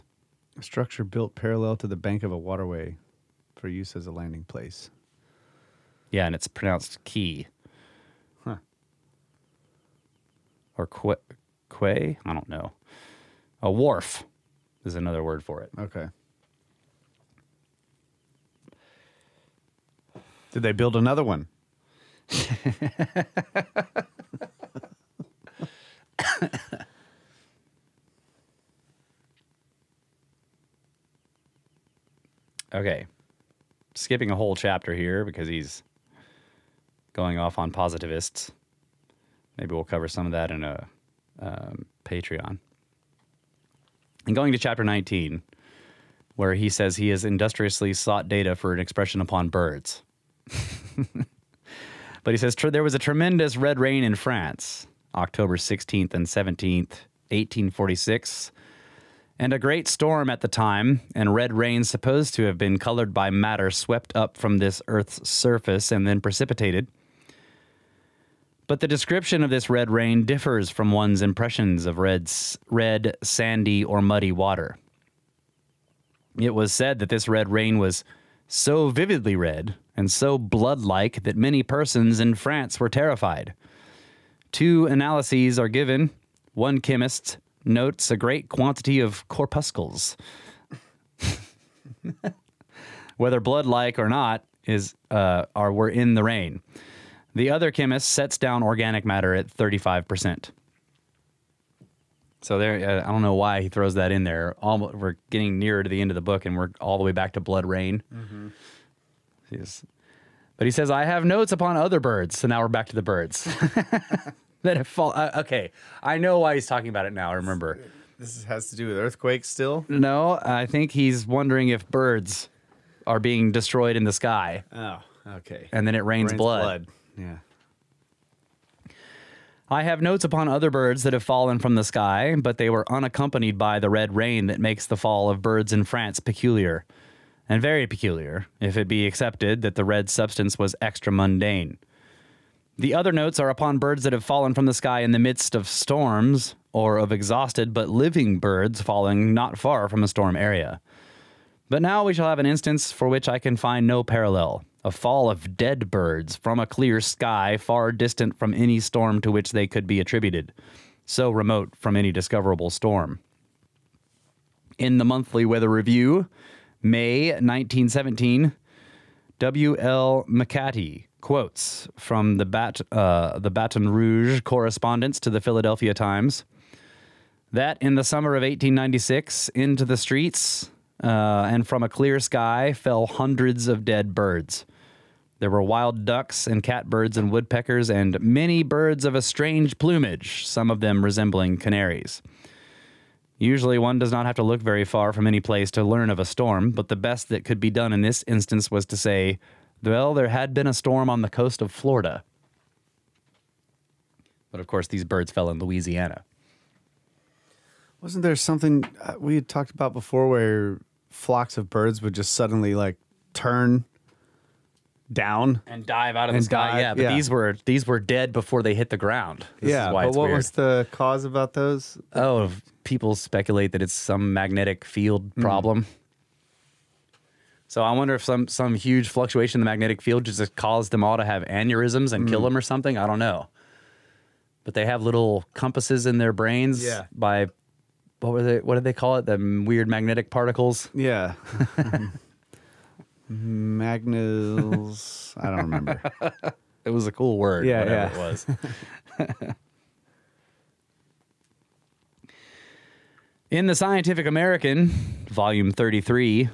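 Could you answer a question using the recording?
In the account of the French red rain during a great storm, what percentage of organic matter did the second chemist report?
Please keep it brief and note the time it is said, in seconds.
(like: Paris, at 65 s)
35%, at 99 s.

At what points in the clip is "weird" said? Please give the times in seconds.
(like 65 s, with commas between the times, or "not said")
220 s, 239 s.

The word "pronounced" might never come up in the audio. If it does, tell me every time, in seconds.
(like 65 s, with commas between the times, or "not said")
6 s.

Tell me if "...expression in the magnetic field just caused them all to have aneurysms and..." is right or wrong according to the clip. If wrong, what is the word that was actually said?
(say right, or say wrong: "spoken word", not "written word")
wrong: "fluctuation", not "expression".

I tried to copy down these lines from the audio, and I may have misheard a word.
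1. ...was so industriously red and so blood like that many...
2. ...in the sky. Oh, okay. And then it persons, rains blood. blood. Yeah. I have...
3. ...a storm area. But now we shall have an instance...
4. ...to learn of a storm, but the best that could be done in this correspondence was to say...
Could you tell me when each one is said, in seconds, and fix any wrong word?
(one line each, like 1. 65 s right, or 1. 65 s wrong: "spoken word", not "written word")
1. 77 s wrong: "vividly", not "industriously"
2. 123 s wrong: "rains", not "persons"
3. 150 s right
4. 195 s wrong: "instance", not "correspondence".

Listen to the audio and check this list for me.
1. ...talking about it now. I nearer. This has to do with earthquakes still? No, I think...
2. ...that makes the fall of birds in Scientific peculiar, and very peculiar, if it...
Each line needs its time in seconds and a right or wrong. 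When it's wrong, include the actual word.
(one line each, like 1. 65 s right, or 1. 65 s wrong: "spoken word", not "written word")
1. 116 s wrong: "remember", not "nearer"
2. 134 s wrong: "France", not "Scientific".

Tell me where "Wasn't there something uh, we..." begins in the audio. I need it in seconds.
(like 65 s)
208 s.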